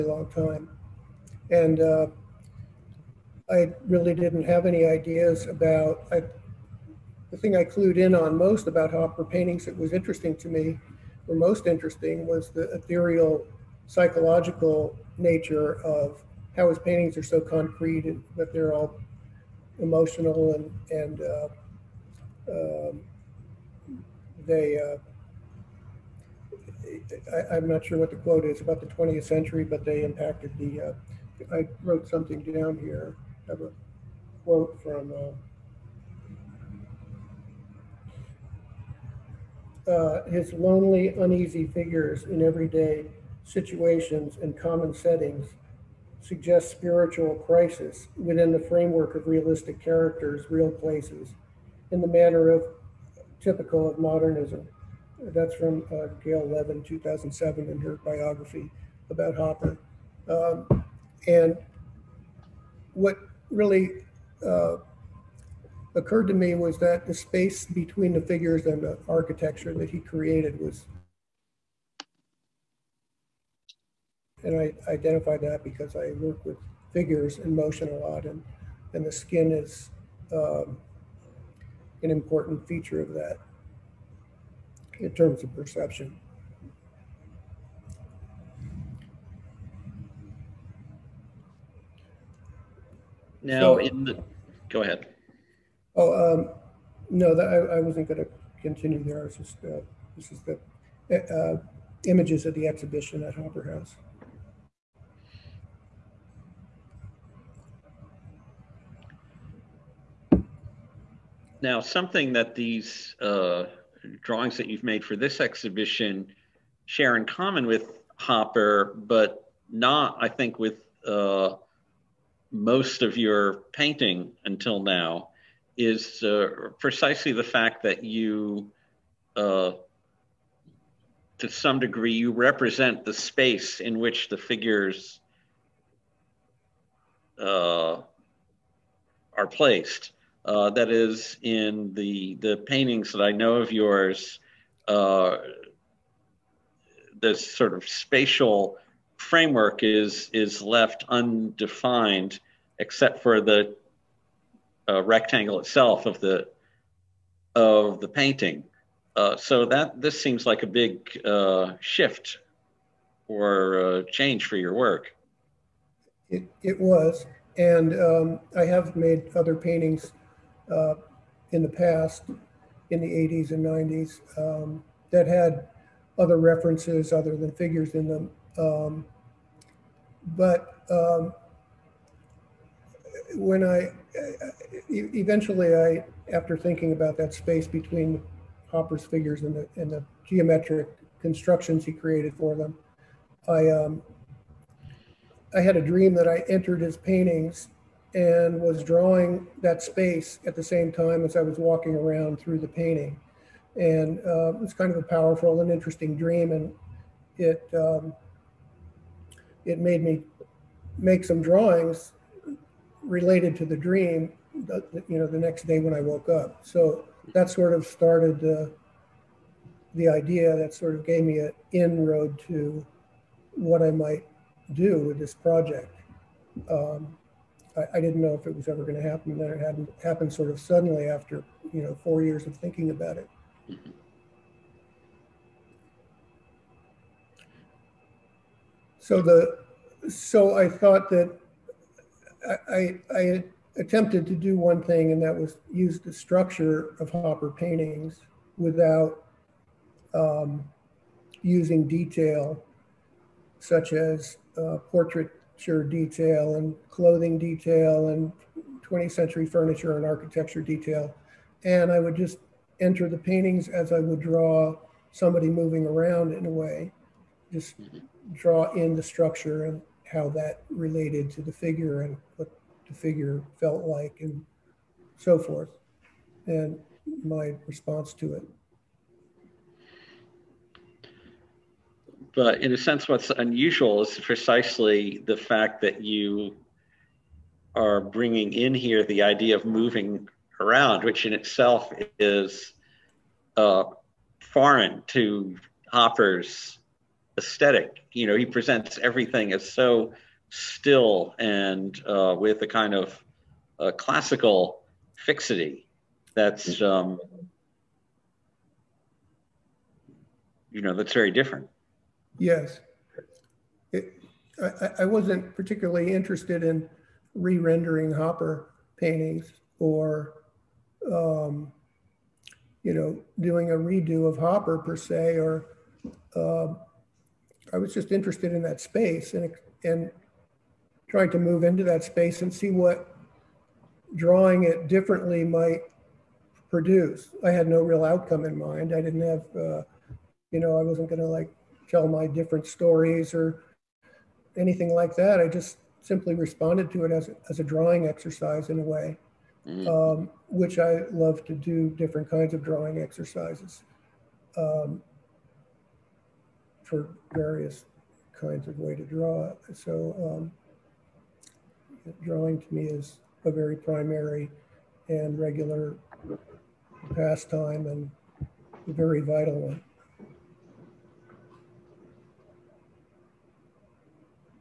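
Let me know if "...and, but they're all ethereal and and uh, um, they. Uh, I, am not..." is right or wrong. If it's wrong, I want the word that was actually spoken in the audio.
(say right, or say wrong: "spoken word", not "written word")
wrong: "emotional", not "ethereal".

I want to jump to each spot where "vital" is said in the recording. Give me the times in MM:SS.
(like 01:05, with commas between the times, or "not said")
06:09.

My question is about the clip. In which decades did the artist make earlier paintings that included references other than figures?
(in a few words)
80s and 90s.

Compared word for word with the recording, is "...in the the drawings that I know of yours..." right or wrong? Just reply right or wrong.
wrong.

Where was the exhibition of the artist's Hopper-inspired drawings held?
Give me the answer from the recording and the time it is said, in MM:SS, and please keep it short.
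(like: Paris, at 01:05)
Hopper House, at 01:43.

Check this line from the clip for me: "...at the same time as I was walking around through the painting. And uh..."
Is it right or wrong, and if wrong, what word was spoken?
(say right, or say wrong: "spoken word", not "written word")
right.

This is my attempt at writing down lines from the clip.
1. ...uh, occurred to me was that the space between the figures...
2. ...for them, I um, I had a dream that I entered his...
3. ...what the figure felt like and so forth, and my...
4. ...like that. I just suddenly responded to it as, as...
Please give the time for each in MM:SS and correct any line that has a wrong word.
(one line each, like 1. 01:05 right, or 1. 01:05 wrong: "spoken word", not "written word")
1. 01:04 right
2. 03:12 right
3. 04:32 right
4. 05:44 wrong: "simply", not "suddenly".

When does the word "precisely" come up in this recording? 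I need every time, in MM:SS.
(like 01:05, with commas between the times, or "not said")
02:06, 04:44.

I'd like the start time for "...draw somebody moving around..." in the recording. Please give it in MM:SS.
04:24.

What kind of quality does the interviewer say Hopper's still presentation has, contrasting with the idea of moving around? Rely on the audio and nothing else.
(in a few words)
classical fixity.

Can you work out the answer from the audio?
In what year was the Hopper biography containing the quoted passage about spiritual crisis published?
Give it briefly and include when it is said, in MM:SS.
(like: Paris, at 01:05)
2007, at 00:56.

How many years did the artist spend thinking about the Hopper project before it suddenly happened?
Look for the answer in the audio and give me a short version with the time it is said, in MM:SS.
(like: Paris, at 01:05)
4, at 03:52.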